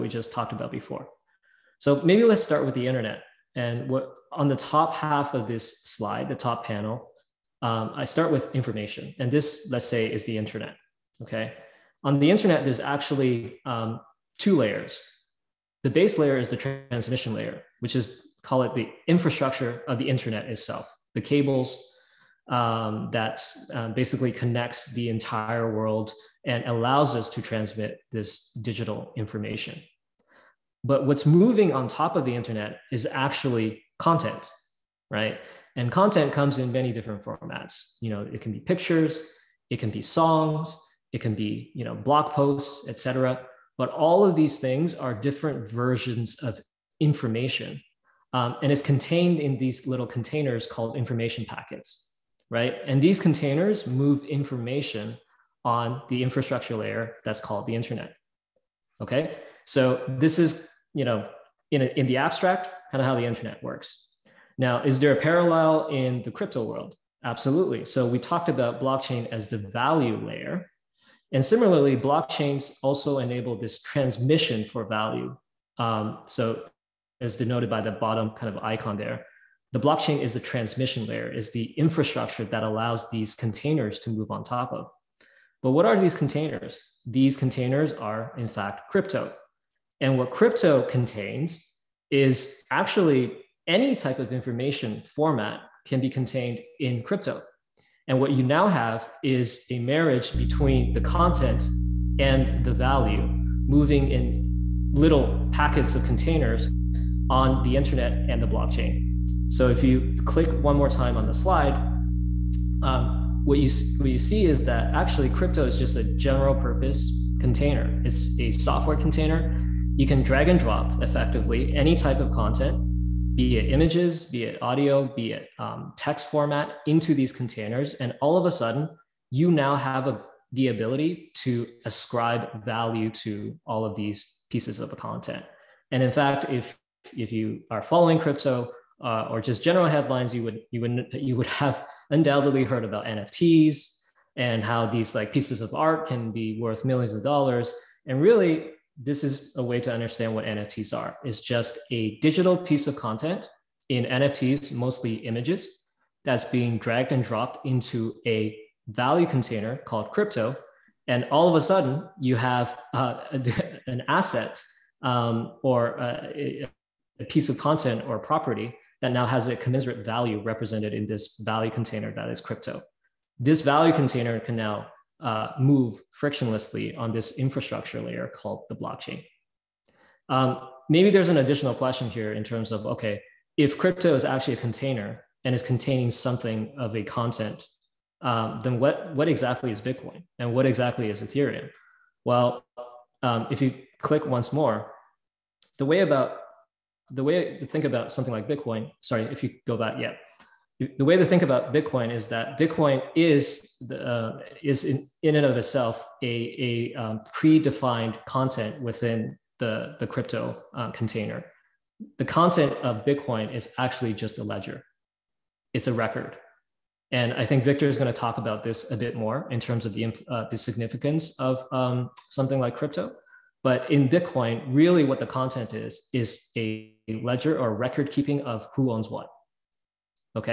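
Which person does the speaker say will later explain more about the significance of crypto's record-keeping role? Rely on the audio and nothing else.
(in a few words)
Victor.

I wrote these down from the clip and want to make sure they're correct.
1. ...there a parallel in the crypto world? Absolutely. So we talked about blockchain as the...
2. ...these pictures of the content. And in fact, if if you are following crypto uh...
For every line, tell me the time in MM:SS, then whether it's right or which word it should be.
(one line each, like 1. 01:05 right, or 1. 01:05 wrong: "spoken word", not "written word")
1. 01:04 right
2. 02:13 wrong: "pieces", not "pictures".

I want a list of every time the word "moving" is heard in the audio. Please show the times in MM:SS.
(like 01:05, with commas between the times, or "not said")
00:31, 01:43.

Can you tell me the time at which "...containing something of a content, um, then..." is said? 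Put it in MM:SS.
03:05.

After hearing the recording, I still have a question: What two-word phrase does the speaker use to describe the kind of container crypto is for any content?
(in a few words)
general purpose container.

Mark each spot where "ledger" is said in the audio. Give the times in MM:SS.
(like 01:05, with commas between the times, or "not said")
03:34, 03:47.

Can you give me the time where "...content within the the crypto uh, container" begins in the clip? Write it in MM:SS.
03:28.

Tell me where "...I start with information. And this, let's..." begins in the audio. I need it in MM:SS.
00:07.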